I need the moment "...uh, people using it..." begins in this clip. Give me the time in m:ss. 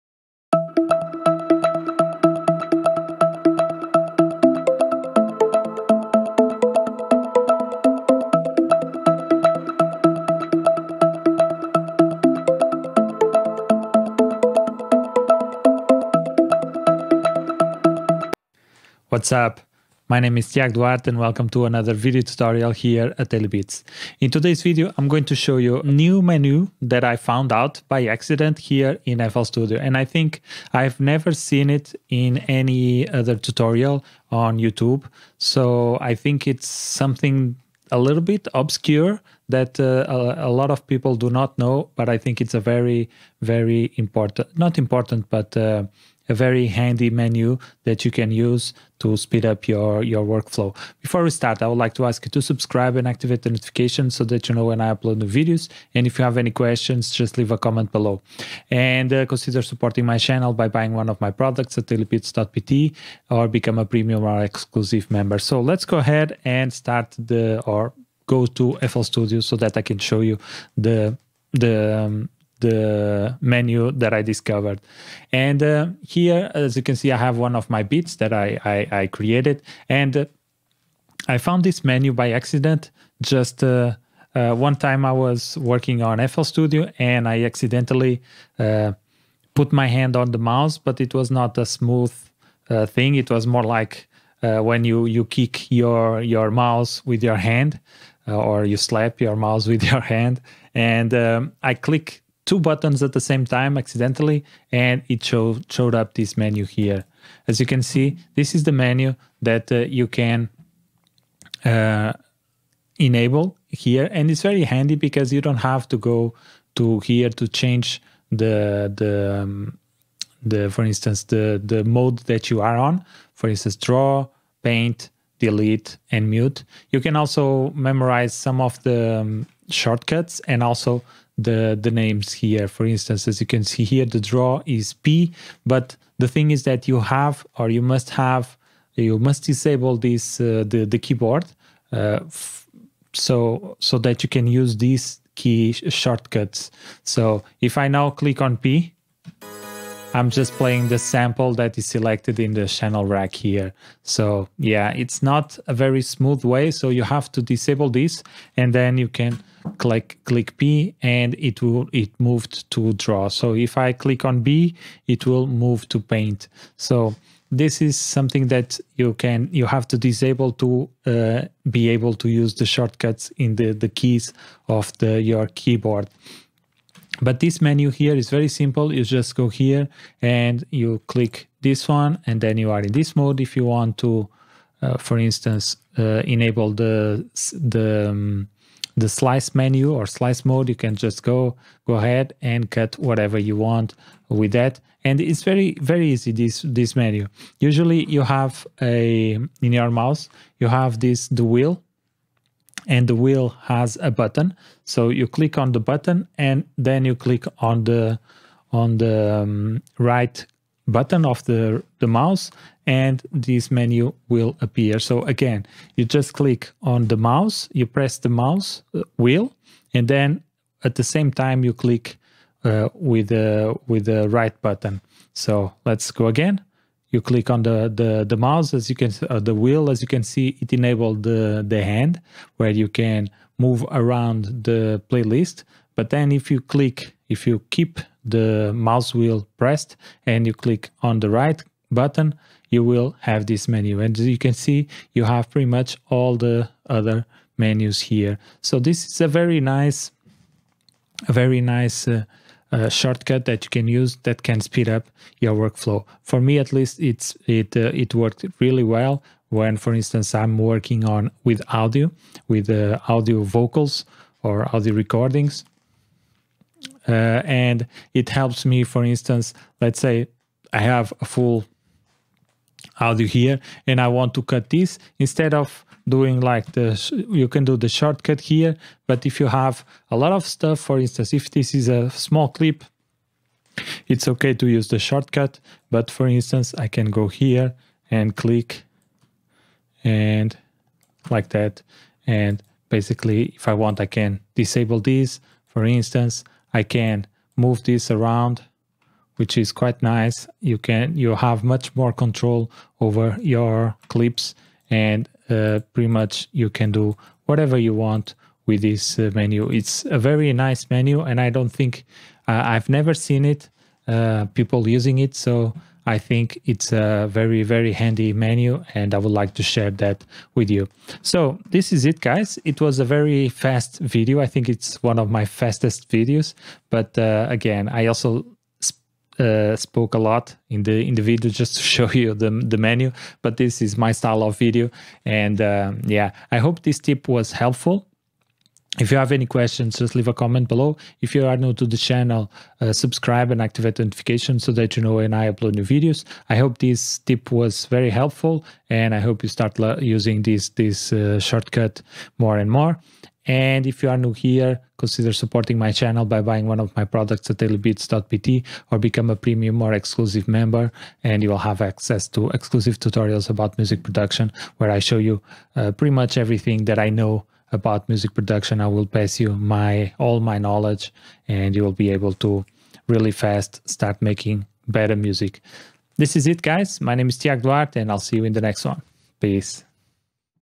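5:14.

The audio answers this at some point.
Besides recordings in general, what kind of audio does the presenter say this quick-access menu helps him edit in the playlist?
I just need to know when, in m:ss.
4:23.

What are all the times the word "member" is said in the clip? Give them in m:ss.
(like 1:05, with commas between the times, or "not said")
1:05, 6:00.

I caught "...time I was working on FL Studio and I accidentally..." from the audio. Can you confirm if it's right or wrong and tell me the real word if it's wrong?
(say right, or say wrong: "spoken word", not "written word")
right.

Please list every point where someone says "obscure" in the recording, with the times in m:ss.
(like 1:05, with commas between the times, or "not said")
0:38.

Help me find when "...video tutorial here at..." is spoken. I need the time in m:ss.
0:21.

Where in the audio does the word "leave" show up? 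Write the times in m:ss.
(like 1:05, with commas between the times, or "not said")
0:57, 5:40.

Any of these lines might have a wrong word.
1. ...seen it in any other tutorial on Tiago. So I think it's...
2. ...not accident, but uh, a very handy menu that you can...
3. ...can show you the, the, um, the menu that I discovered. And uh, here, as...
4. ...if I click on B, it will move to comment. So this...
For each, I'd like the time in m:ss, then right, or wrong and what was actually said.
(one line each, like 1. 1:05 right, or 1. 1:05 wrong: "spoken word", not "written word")
1. 0:31 wrong: "YouTube", not "Tiago"
2. 0:44 wrong: "important", not "accident"
3. 1:09 right
4. 2:43 wrong: "paint", not "comment".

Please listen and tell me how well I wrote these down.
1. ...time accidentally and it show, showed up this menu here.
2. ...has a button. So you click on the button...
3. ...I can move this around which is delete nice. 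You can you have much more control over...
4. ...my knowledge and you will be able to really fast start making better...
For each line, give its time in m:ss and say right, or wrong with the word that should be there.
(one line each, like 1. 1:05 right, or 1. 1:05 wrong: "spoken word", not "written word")
1. 1:43 right
2. 3:23 right
3. 4:56 wrong: "quite", not "delete"
4. 6:10 right.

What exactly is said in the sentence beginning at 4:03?
And as you can see, you have pretty much all the other menus here.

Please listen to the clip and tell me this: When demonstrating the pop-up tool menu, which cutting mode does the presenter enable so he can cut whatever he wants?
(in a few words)
slice mode.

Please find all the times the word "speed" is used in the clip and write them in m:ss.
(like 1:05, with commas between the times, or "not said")
0:49, 4:14.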